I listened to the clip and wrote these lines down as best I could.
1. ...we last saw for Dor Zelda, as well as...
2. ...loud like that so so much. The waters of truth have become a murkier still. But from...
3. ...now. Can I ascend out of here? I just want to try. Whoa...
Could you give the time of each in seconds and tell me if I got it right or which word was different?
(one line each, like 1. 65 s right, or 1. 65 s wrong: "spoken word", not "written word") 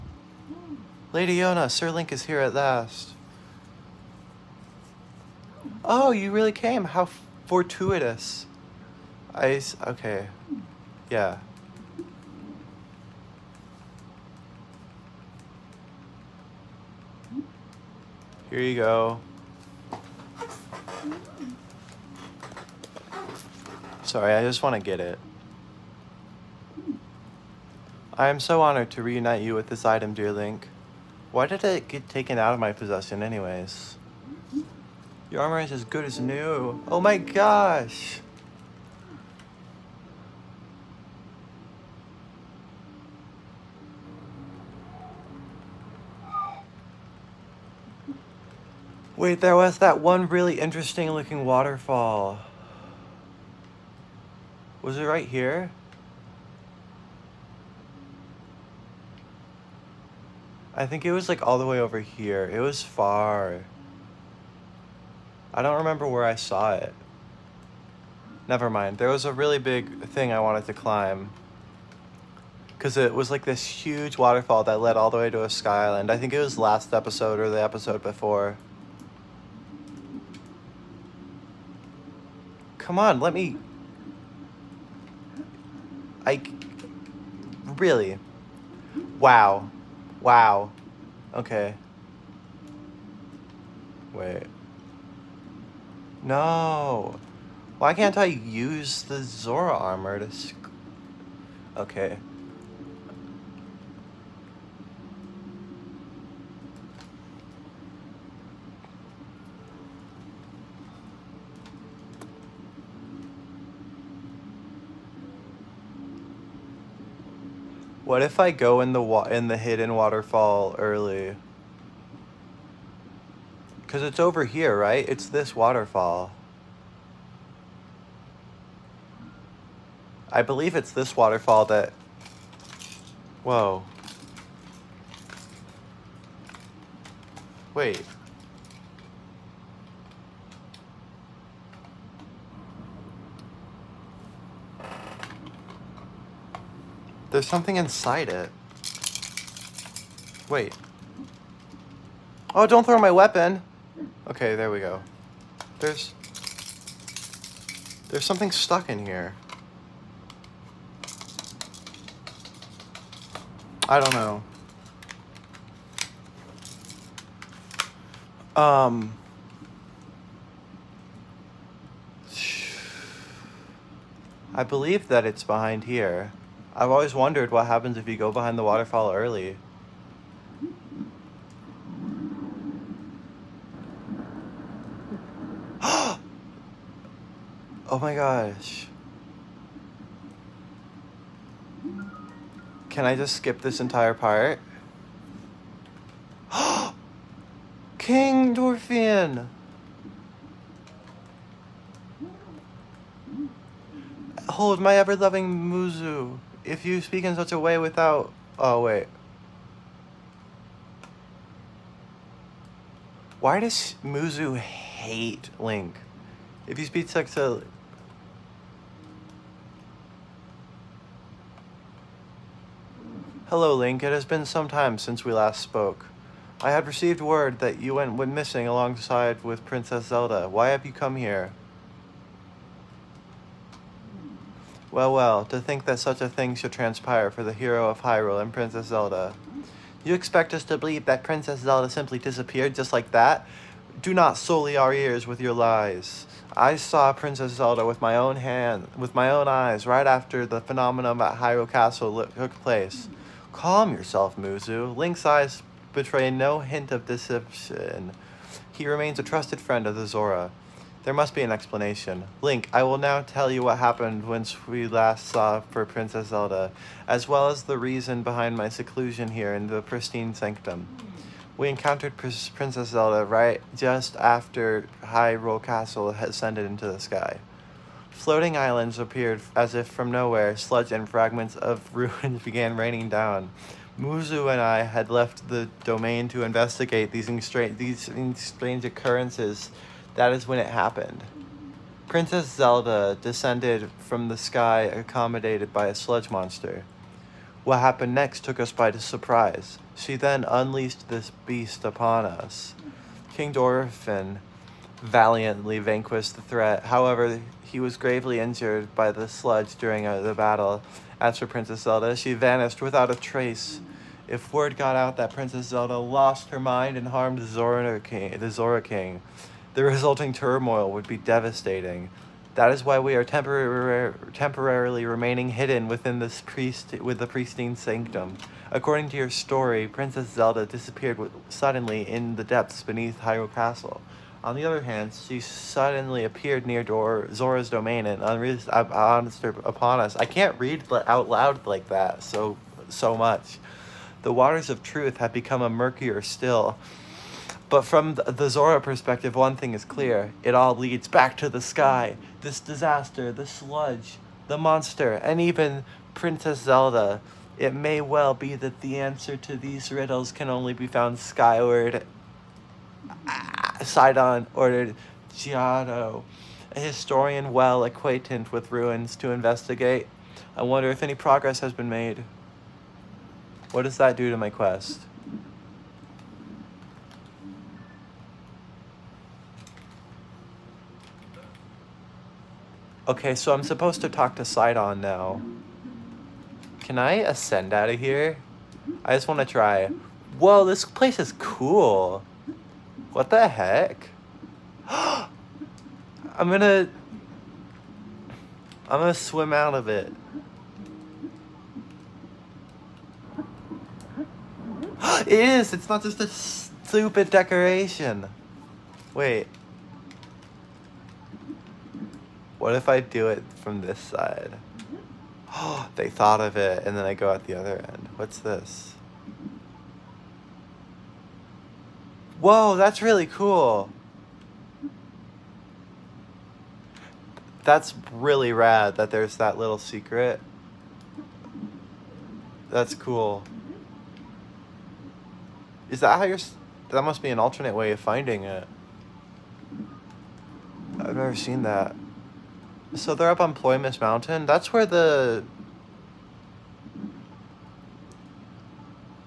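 1. 264 s wrong: "Princess", not "Dor"
2. 341 s right
3. 385 s right.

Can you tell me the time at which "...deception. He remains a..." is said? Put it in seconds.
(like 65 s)
257 s.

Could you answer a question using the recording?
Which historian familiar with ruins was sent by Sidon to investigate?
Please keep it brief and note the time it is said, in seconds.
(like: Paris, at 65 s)
Jiahto, at 365 s.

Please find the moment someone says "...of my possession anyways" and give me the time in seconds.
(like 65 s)
32 s.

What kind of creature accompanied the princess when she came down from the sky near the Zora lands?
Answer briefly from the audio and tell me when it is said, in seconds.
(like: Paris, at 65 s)
sludge monster, at 295 s.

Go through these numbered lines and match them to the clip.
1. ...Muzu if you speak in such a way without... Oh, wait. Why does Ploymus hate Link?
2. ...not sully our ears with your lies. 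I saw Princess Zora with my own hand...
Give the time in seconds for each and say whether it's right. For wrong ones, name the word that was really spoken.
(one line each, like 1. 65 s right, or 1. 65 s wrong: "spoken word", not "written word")
1. 205 s wrong: "Muzu", not "Ploymus"
2. 244 s wrong: "Zelda", not "Zora".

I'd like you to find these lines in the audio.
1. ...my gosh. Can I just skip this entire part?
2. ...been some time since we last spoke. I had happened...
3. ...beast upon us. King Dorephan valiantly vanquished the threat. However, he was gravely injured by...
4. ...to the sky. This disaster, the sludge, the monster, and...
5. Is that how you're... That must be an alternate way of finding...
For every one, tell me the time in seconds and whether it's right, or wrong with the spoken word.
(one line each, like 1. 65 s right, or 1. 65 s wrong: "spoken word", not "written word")
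1. 188 s right
2. 224 s wrong: "received", not "happened"
3. 301 s right
4. 351 s right
5. 435 s right.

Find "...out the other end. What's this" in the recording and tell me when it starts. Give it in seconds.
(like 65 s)
417 s.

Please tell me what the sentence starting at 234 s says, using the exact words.
Well, well, to think that such a thing should transpire for the hero of Hyrule and Princess Zelda.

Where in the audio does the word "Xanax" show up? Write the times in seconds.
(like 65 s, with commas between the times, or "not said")
not said.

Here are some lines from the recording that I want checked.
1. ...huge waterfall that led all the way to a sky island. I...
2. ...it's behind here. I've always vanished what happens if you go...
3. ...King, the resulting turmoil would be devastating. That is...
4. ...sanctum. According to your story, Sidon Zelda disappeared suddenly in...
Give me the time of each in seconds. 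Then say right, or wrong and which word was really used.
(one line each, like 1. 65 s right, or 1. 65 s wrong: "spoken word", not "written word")
1. 73 s right
2. 175 s wrong: "wondered", not "vanished"
3. 318 s right
4. 327 s wrong: "Princess", not "Sidon".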